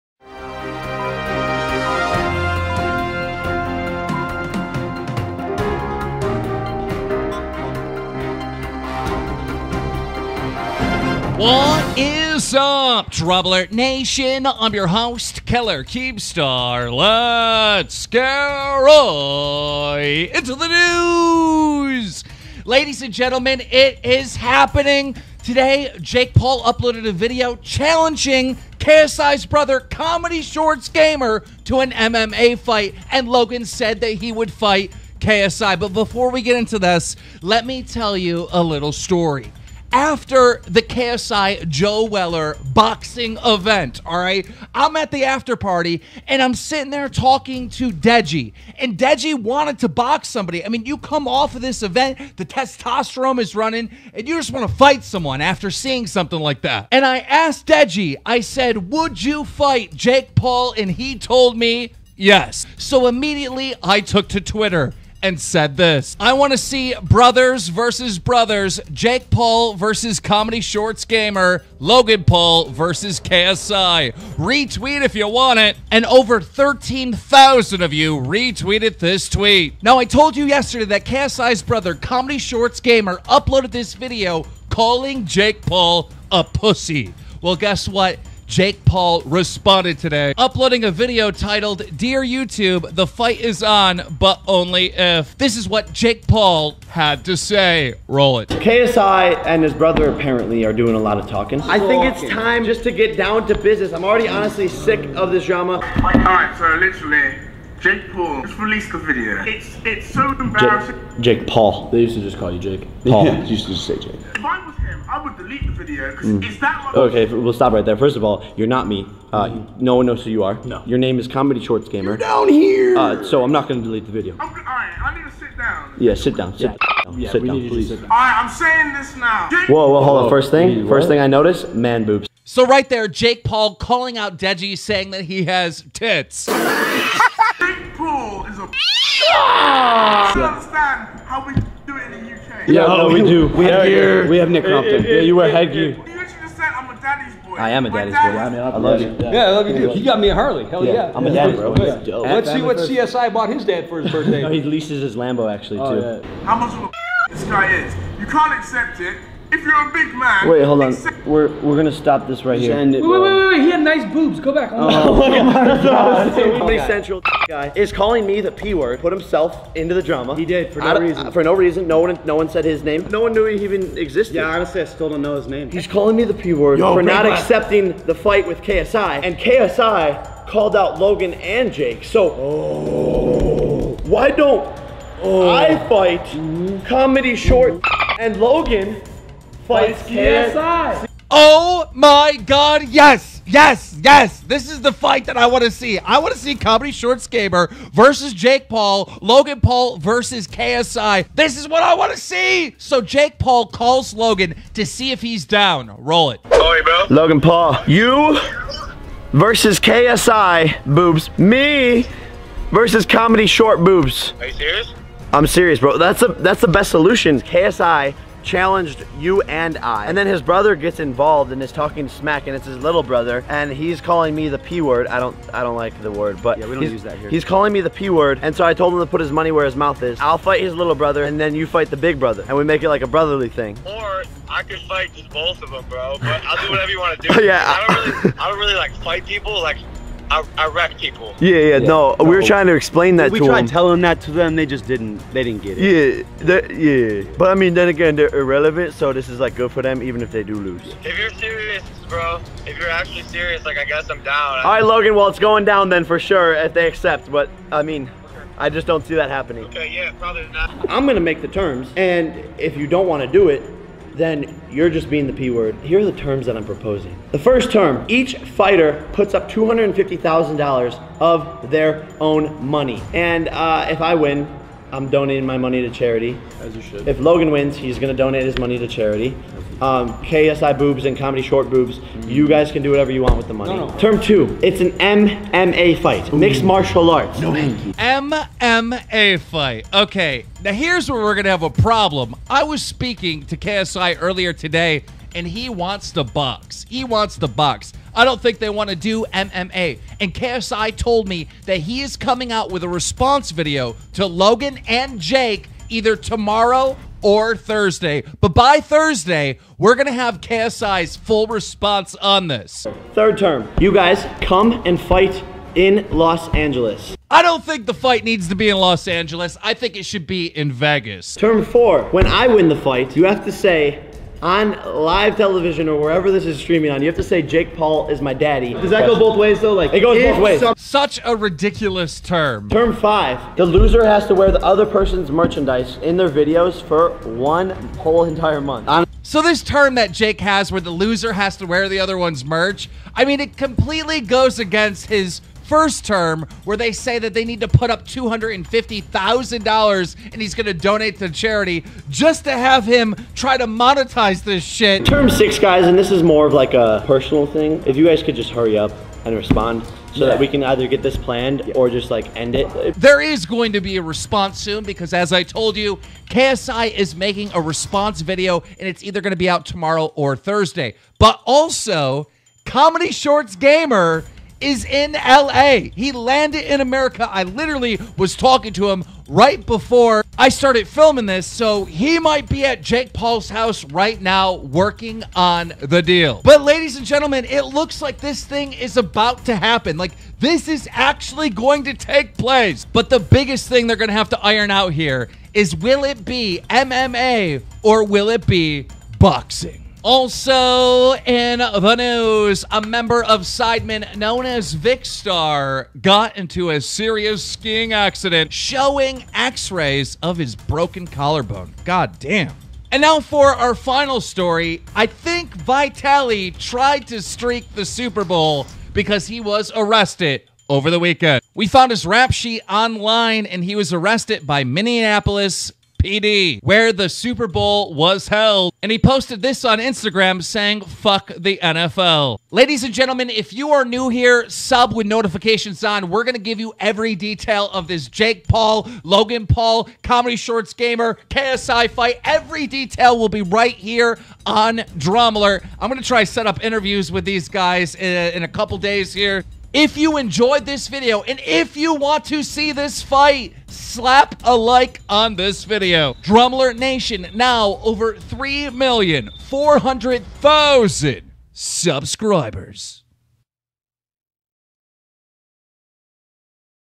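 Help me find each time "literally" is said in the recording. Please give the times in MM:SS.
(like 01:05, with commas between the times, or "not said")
01:46, 06:17.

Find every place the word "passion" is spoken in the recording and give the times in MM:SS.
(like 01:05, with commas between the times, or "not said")
not said.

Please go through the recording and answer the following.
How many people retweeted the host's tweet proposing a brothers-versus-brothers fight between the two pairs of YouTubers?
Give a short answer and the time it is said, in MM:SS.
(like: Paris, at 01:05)
13,000, at 01:16.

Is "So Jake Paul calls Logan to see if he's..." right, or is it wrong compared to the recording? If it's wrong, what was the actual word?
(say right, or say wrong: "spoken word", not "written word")
right.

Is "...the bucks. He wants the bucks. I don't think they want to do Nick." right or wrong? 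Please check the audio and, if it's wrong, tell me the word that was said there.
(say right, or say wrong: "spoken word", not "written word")
wrong: "MMA", not "Nick".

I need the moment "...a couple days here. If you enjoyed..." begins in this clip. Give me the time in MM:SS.
07:28.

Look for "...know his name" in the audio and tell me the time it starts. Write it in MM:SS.
02:55.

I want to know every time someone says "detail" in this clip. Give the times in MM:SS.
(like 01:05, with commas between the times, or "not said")
07:17, 07:22.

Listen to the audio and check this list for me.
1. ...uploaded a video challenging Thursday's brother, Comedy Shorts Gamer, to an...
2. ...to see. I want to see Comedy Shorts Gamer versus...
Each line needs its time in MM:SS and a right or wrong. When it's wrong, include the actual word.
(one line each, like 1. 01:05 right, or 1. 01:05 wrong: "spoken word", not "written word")
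1. 00:26 wrong: "KSI", not "Thursday"
2. 03:15 right.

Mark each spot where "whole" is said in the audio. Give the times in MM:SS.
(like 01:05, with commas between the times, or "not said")
05:37.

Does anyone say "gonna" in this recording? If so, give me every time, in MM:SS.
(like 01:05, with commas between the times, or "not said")
02:41, 04:21, 04:37, 04:51.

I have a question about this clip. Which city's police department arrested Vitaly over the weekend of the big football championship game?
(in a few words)
Minneapolis.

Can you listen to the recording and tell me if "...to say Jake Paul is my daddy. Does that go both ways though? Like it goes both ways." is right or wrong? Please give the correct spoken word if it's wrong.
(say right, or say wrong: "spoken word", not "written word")
right.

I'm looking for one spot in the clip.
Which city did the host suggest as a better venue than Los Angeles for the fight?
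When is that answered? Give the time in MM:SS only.
05:20.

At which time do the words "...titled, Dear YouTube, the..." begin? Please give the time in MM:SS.
01:31.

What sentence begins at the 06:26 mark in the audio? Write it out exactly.
But, ladies and gentlemen, it looks like this thing is about to happen.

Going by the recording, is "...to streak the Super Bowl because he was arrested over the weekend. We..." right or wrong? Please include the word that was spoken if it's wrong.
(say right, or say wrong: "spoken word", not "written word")
right.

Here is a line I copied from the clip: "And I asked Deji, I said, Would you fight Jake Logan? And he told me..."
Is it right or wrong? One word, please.
wrong.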